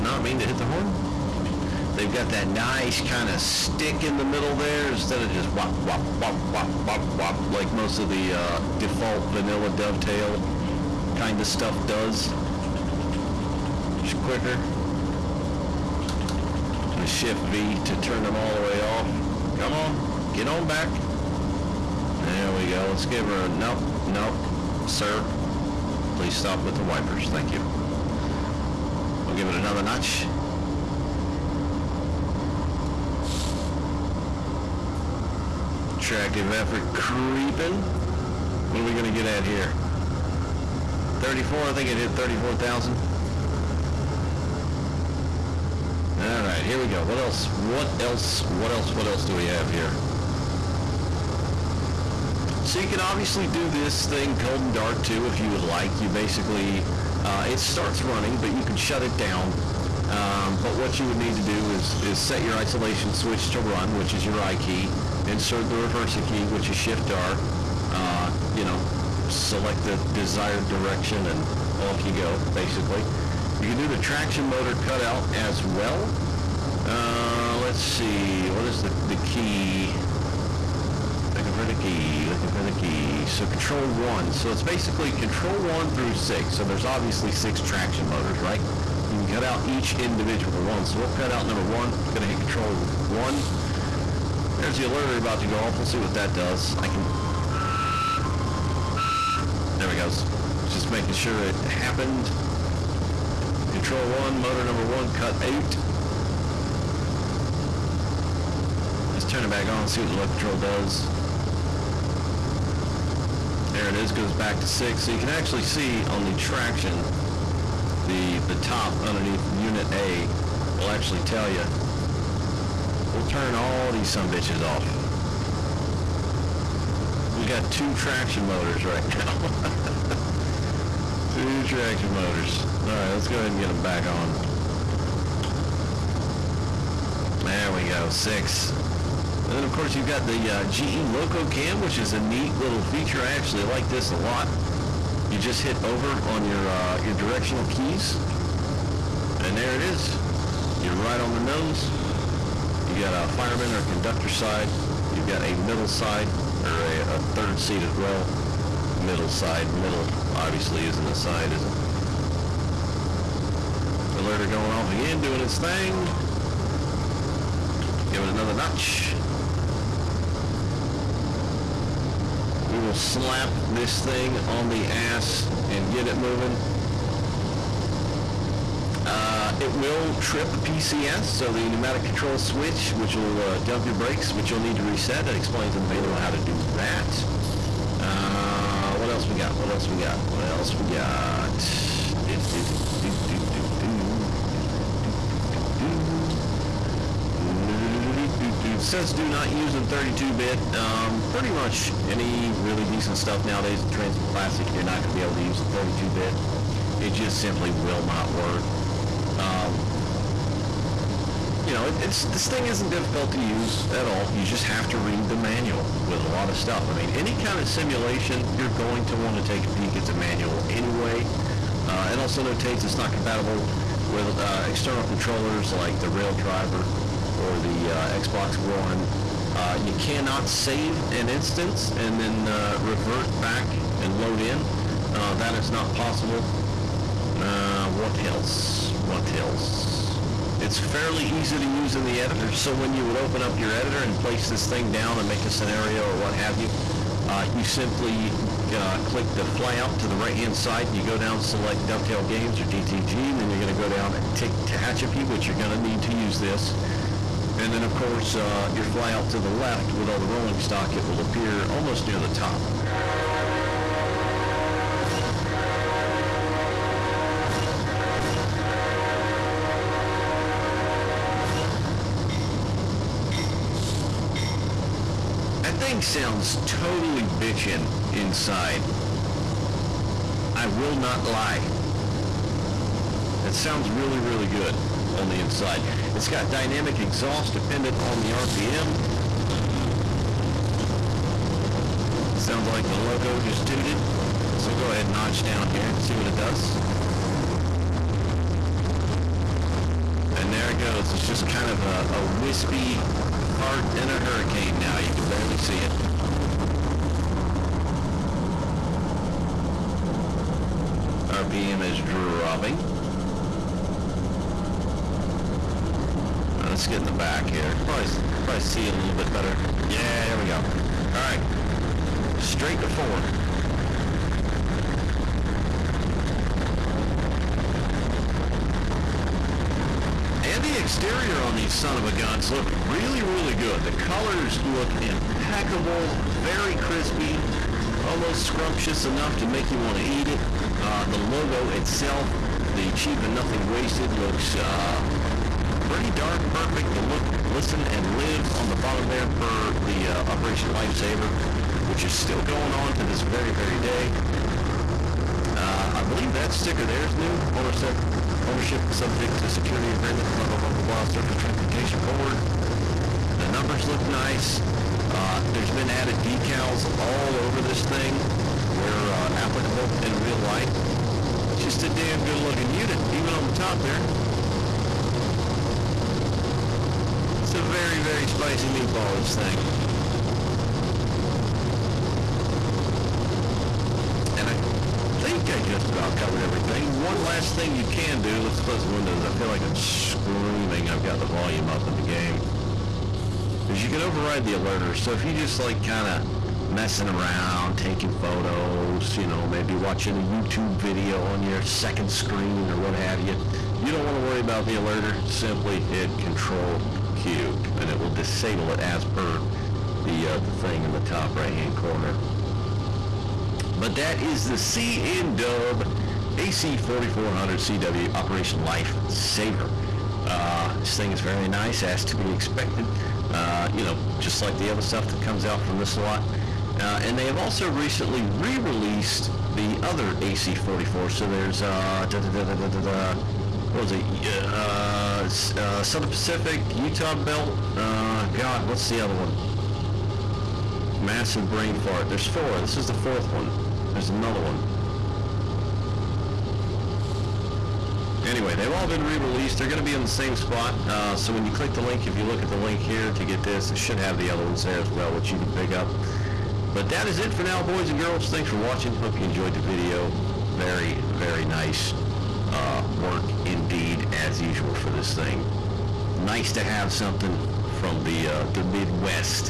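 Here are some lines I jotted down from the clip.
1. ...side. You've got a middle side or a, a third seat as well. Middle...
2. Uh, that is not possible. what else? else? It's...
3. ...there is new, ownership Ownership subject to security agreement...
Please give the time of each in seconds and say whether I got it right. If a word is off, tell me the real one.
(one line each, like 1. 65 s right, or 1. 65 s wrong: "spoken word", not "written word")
1. 154 s right
2. 235 s right
3. 356 s right.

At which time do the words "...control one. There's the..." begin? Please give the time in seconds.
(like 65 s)
92 s.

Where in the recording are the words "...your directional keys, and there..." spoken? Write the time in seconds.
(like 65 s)
147 s.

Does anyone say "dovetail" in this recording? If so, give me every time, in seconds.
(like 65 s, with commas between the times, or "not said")
9 s, 251 s.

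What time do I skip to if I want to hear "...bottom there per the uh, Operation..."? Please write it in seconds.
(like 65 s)
348 s.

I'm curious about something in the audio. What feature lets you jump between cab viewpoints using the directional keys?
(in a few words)
GE Loco Cam.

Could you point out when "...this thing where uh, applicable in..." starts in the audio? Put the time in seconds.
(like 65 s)
367 s.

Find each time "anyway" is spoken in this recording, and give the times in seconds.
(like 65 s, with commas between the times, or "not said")
220 s, 448 s.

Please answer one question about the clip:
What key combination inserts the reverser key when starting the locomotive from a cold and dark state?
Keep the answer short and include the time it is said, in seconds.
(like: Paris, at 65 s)
Shift R, at 66 s.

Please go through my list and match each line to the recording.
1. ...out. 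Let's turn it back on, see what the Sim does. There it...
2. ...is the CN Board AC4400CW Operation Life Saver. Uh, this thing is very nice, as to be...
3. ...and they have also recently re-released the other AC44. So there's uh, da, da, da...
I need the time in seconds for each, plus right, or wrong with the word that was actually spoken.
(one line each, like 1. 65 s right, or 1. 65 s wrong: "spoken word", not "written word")
1. 105 s wrong: "Locotrol", not "Sim"
2. 414 s wrong: "Dub", not "Board"
3. 427 s right.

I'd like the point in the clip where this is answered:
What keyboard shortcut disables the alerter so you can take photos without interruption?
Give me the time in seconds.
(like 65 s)
406 s.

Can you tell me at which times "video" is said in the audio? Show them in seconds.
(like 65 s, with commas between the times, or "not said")
400 s, 459 s.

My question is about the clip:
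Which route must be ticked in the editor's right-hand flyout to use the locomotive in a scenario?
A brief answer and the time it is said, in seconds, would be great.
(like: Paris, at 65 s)
Tehachapi, at 254 s.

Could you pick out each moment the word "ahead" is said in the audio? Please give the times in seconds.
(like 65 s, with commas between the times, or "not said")
133 s, 294 s.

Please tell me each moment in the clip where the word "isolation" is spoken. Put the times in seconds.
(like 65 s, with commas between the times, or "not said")
62 s.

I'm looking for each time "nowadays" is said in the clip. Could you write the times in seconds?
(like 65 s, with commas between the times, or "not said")
203 s.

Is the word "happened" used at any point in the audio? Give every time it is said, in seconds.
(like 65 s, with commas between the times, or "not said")
101 s.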